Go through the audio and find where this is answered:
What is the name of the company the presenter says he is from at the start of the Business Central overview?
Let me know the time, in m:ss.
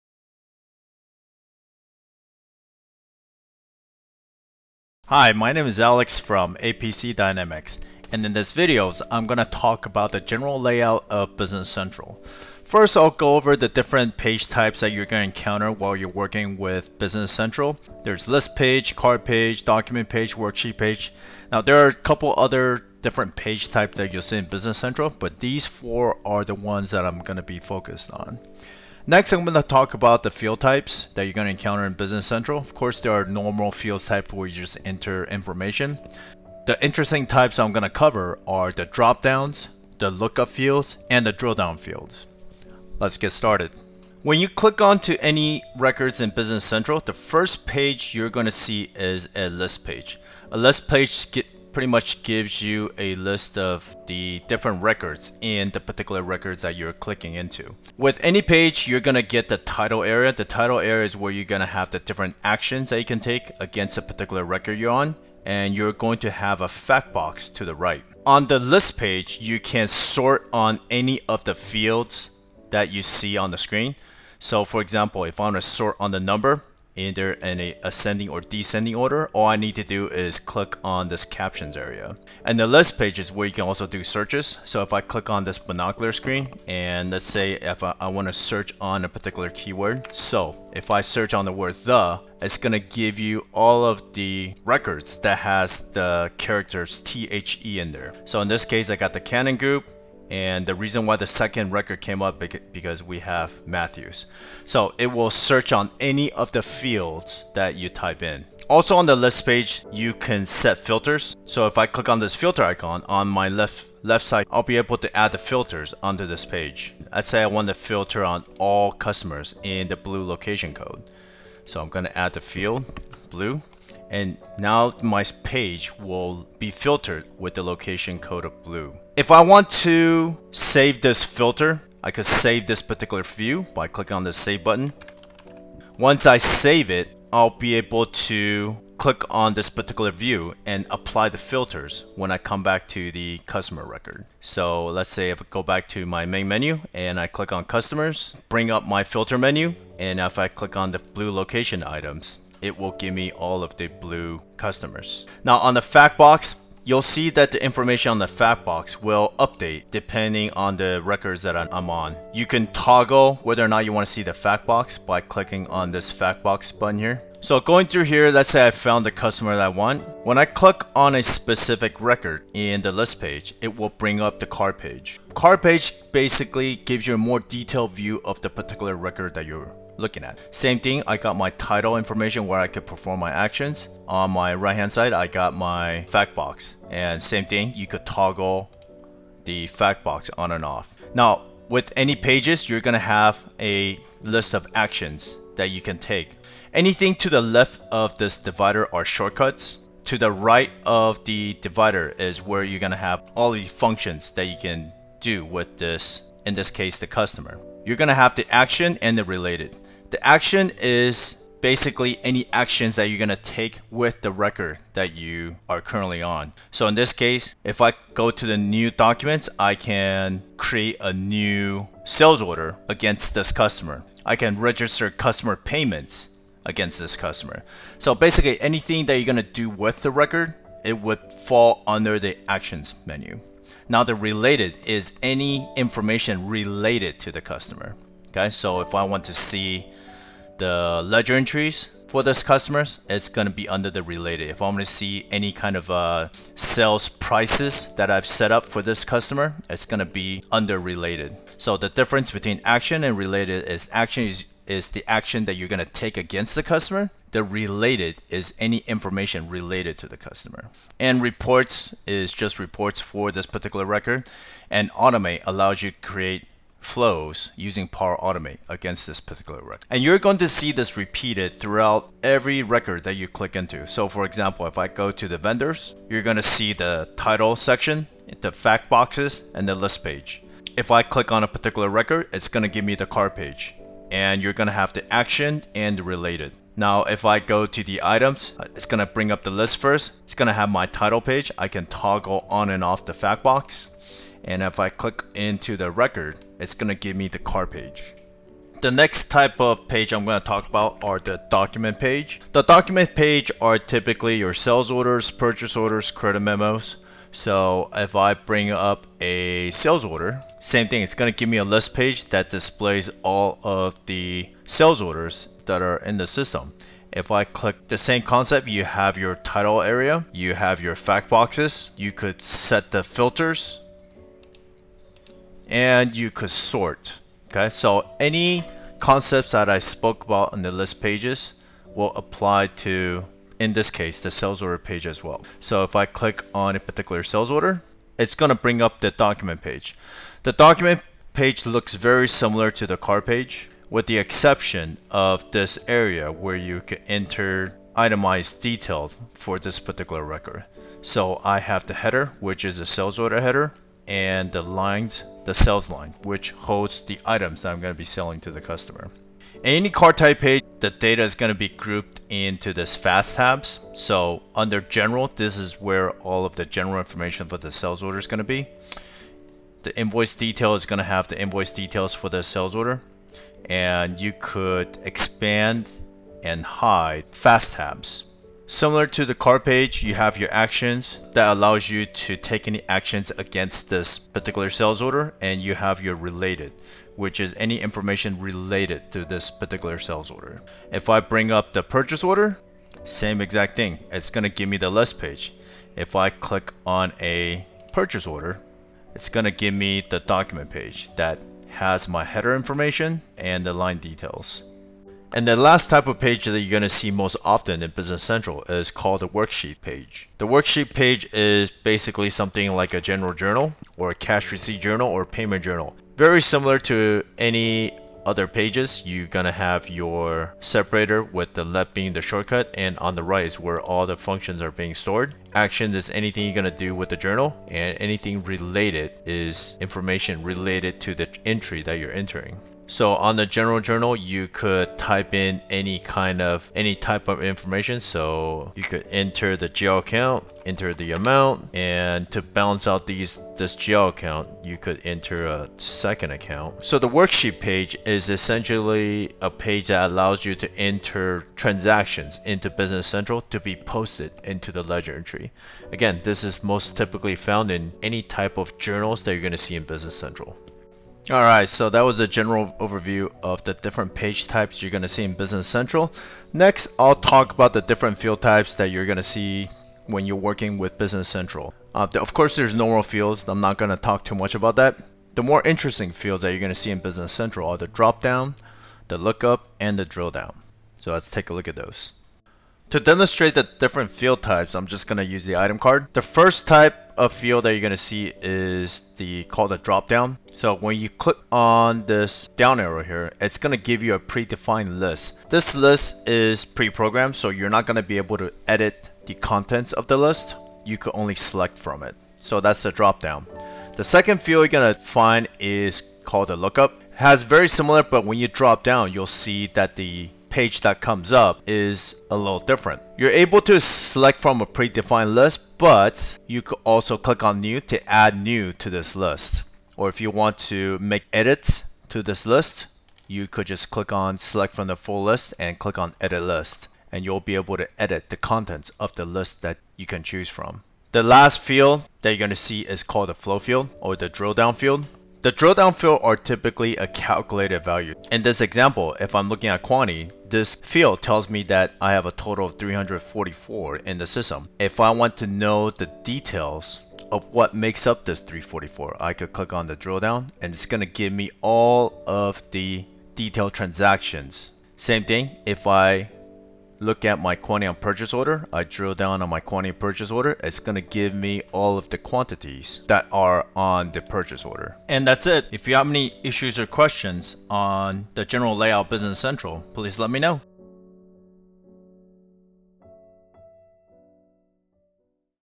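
0:06.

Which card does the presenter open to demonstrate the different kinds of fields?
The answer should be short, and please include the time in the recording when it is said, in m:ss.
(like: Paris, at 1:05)
item card, at 8:05.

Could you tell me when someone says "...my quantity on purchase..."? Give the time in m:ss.
9:17.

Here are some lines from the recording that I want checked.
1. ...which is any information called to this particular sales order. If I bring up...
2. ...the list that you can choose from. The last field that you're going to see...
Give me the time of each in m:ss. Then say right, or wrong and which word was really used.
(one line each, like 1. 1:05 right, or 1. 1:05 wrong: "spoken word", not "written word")
1. 6:27 wrong: "related", not "called"
2. 8:49 right.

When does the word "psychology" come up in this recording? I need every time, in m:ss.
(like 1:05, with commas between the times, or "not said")
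not said.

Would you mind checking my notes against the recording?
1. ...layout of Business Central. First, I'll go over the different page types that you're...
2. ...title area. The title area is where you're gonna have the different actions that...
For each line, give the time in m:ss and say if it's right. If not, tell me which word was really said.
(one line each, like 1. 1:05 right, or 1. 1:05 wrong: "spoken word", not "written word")
1. 0:10 right
2. 0:59 right.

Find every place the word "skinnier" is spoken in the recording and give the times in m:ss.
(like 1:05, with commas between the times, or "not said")
not said.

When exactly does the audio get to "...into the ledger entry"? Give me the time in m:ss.
7:34.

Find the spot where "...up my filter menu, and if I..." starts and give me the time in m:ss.
2:28.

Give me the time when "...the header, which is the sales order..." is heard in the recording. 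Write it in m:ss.
5:51.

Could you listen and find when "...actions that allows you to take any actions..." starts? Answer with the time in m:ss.
6:20.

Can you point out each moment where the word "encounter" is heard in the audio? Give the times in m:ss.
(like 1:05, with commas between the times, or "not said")
0:15, 0:31.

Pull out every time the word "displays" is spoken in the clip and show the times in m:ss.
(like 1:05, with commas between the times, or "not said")
5:12.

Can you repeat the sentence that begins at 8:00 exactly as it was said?
So let's take a look at those.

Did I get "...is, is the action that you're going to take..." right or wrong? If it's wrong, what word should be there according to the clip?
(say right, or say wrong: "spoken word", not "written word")
right.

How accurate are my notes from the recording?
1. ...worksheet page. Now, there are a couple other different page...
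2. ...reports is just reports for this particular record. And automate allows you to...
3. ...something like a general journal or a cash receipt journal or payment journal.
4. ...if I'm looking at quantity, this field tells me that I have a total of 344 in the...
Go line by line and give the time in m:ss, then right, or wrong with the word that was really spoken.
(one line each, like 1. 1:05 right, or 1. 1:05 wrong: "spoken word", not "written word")
1. 0:20 right
2. 4:21 right
3. 6:52 right
4. 8:59 right.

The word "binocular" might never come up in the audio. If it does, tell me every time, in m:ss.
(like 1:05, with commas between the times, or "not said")
1:25.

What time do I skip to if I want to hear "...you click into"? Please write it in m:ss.
4:33.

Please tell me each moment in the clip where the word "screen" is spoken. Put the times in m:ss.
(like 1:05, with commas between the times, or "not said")
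1:13, 1:26.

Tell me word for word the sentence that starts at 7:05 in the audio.
Action is anything you're gonna do with the journal and anything related is information related to the entry that you're entering.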